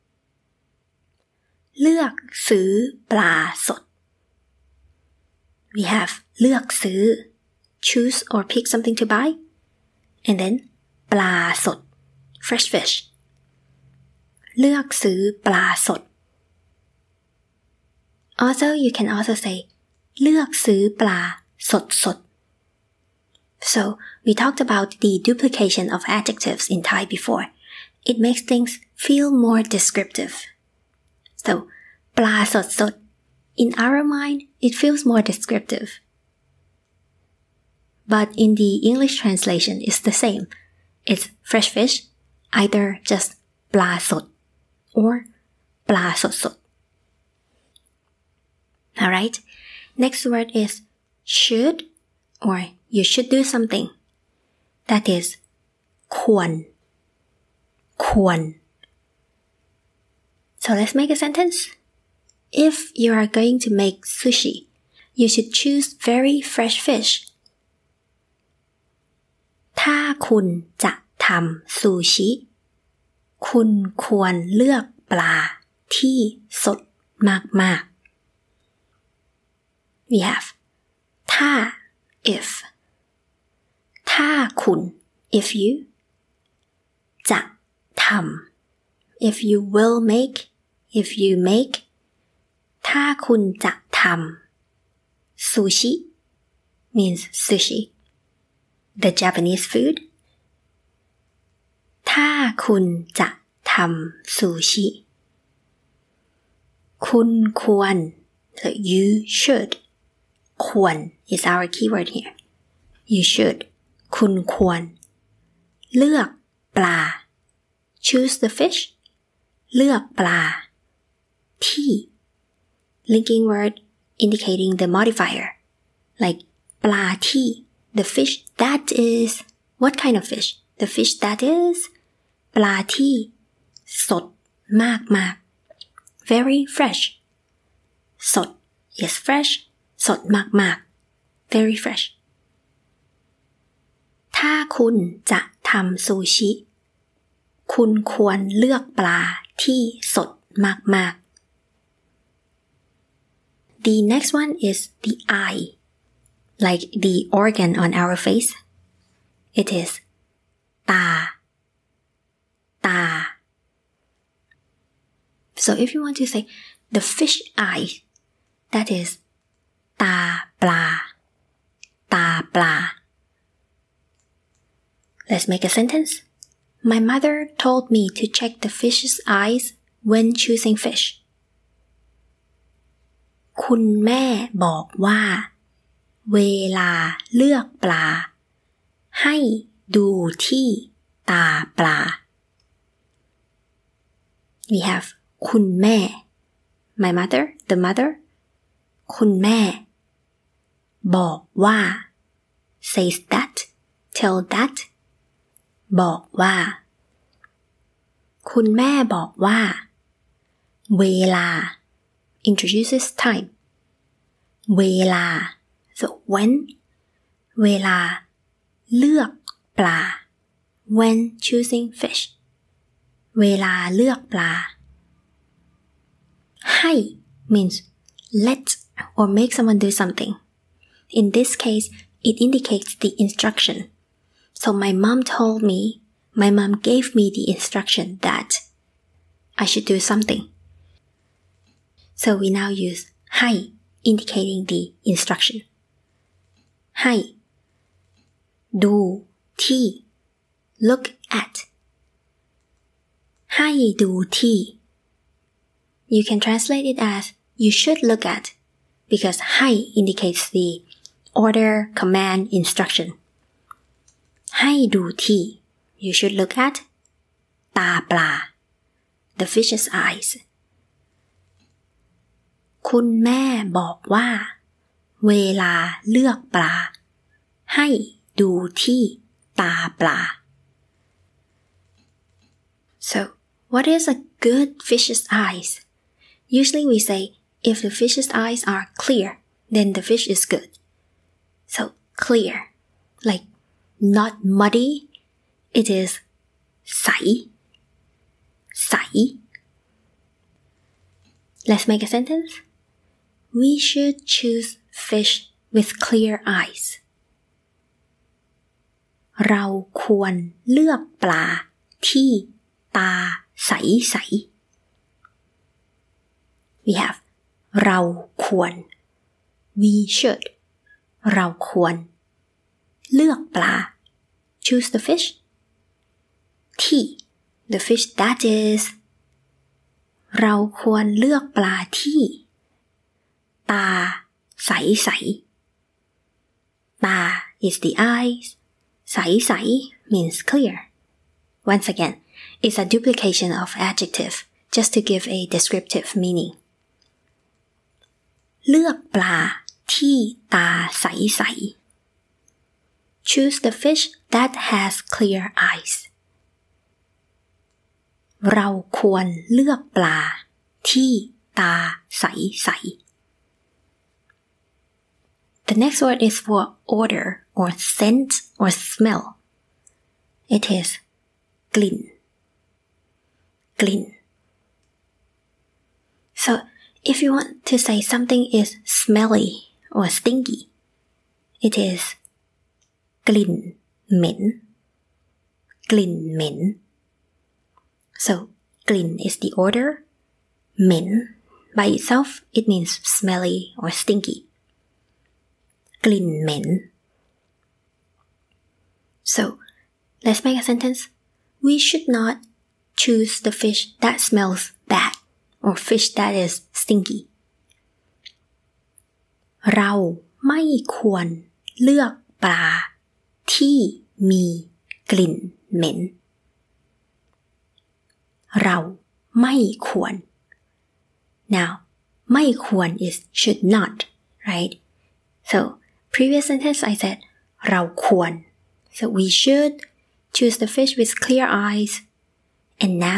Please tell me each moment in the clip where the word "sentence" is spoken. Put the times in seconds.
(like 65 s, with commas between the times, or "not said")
61 s, 175 s, 302 s, 400 s, 426 s.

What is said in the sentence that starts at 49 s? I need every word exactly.
Alright, next word is should or you should do something.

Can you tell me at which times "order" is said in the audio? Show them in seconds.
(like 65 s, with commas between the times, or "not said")
261 s, 389 s.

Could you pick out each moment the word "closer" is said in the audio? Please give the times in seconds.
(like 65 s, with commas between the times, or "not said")
not said.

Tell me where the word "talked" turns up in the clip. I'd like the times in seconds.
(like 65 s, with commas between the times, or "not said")
24 s.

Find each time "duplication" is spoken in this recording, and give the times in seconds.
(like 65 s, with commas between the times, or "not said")
25 s, 342 s.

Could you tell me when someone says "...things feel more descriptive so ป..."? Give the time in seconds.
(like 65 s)
28 s.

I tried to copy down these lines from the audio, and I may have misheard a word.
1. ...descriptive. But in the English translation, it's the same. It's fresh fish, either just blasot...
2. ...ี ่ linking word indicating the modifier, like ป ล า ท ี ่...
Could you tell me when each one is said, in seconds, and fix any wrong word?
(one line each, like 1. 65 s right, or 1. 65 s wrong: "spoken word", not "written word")
1. 35 s right
2. 121 s right.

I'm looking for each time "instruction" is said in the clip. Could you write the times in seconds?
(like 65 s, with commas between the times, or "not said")
233 s, 237 s, 245 s, 262 s.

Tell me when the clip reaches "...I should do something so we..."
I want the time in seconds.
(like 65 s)
239 s.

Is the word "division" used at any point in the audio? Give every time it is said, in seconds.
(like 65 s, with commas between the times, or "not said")
not said.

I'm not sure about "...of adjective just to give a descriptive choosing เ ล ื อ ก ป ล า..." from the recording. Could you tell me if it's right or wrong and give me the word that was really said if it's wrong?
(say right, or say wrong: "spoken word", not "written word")
wrong: "meaning", not "choosing".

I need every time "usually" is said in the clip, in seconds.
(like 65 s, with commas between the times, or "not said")
286 s.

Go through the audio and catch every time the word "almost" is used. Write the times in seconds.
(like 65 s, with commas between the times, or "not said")
not said.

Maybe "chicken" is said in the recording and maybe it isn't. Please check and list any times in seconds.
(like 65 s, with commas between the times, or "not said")
not said.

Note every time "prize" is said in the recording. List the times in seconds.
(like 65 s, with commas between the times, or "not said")
not said.